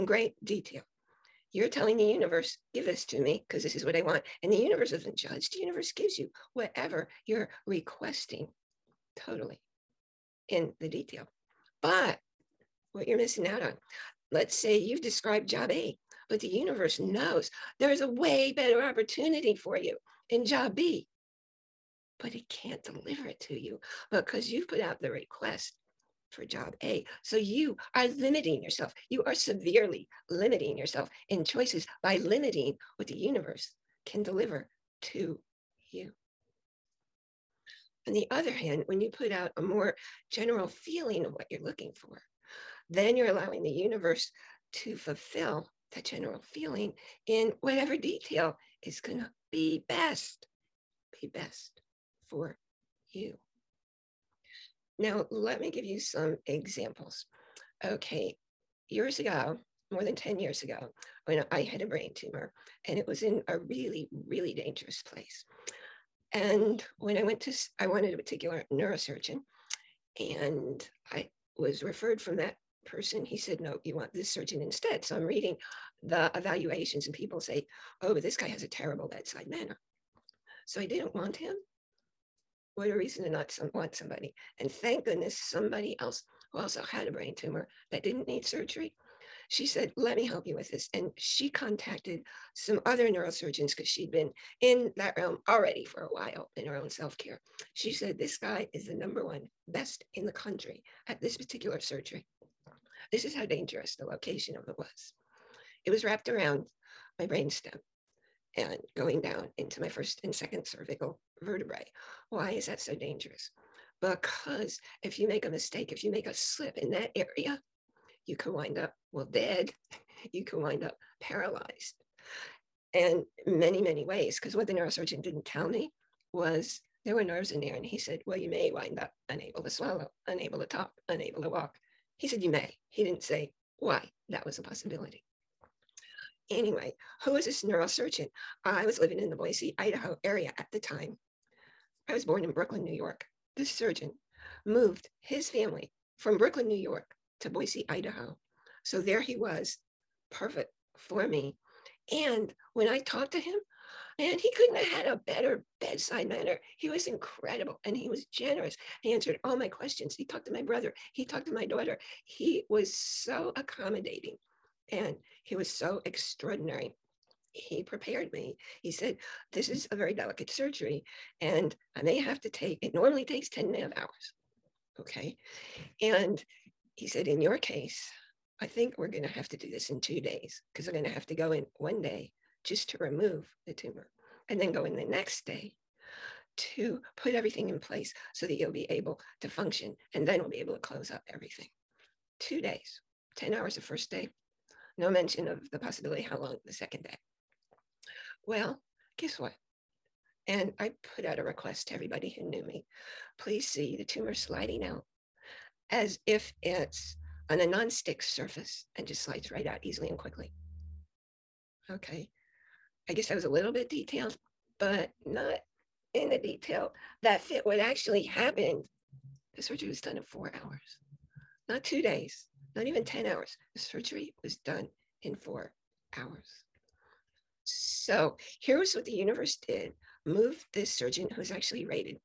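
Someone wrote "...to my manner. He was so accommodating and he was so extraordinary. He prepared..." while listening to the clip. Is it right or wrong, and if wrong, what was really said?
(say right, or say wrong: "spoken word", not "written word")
wrong: "daughter", not "manner".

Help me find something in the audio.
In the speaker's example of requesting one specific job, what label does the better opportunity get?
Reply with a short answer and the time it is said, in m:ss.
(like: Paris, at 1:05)
job B, at 0:20.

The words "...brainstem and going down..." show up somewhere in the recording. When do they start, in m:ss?
1:47.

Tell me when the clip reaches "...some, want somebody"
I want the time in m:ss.
1:23.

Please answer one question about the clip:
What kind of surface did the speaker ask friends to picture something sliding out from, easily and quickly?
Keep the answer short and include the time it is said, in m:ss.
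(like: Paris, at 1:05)
non-stick surface, at 3:27.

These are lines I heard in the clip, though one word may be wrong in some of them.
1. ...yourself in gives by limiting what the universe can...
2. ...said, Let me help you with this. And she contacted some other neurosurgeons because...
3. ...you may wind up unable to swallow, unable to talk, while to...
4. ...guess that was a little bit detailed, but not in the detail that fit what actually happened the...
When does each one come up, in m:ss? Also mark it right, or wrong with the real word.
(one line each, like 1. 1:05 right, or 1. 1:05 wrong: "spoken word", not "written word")
1. 0:30 wrong: "choices", not "gives"
2. 1:29 right
3. 2:08 wrong: "unable", not "while"
4. 3:33 right.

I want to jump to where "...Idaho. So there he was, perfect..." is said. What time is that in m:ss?
2:27.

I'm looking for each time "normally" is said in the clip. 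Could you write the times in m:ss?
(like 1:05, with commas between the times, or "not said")
2:52.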